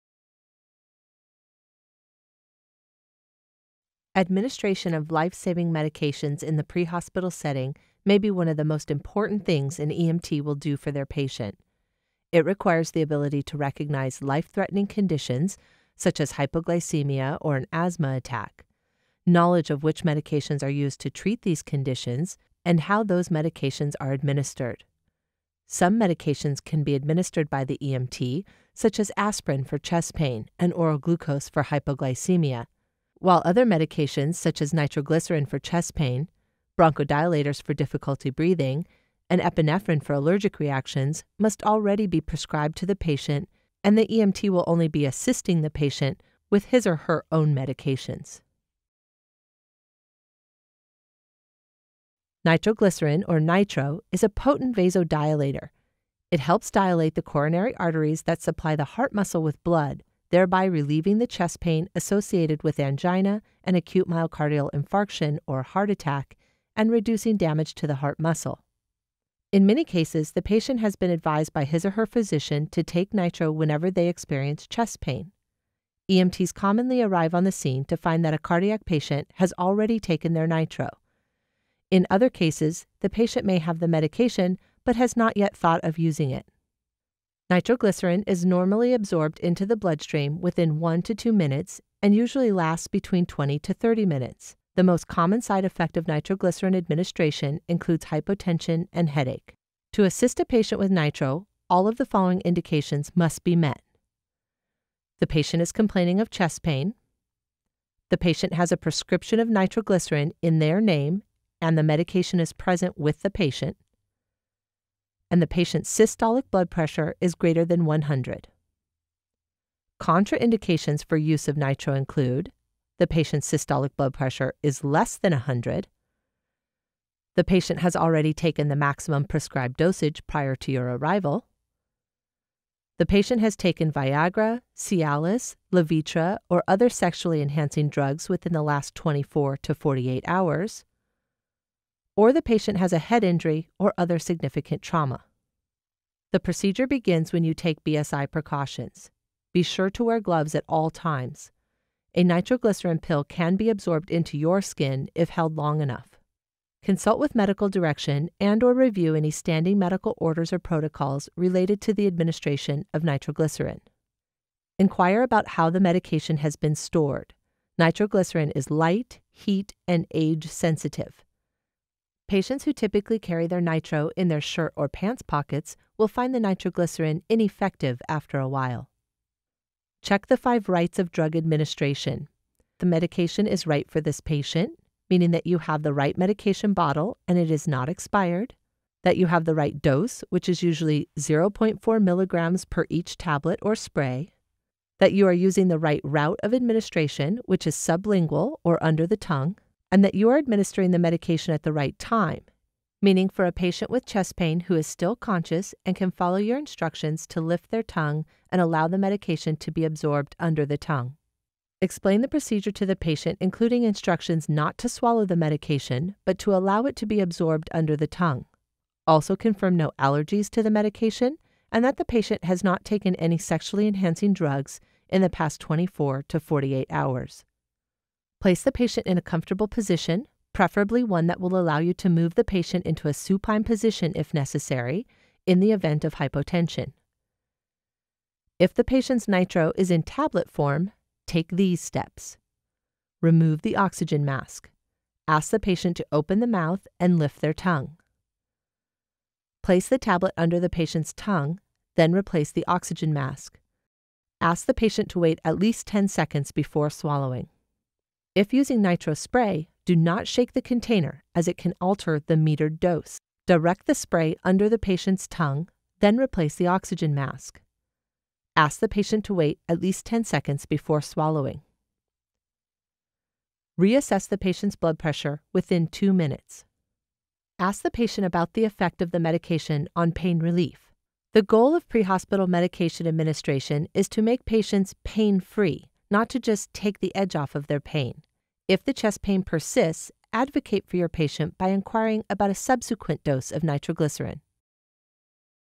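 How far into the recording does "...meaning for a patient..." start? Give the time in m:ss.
3:23.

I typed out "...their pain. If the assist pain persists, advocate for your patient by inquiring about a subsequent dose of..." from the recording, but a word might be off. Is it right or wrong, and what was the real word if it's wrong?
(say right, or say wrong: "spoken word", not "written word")
wrong: "chest", not "assist".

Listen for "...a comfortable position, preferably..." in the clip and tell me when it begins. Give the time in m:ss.
3:49.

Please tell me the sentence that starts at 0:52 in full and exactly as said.
Nitroglycerin, or nitro, is a potent vasodilator.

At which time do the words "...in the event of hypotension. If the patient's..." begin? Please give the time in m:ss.
3:55.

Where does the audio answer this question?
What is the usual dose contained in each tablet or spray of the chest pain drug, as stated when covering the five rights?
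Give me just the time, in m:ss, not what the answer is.
3:11.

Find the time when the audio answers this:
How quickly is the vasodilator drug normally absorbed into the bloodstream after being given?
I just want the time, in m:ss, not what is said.
1:30.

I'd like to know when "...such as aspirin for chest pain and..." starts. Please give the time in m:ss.
0:28.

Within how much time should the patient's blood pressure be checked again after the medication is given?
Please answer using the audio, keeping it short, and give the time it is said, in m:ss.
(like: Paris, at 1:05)
2 minutes, at 4:35.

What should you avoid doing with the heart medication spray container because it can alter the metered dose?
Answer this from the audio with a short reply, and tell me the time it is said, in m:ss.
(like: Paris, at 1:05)
shake, at 4:20.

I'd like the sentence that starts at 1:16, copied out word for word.
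EMTs commonly arrive on the scene to find that a cardiac patient has already taken their nitro.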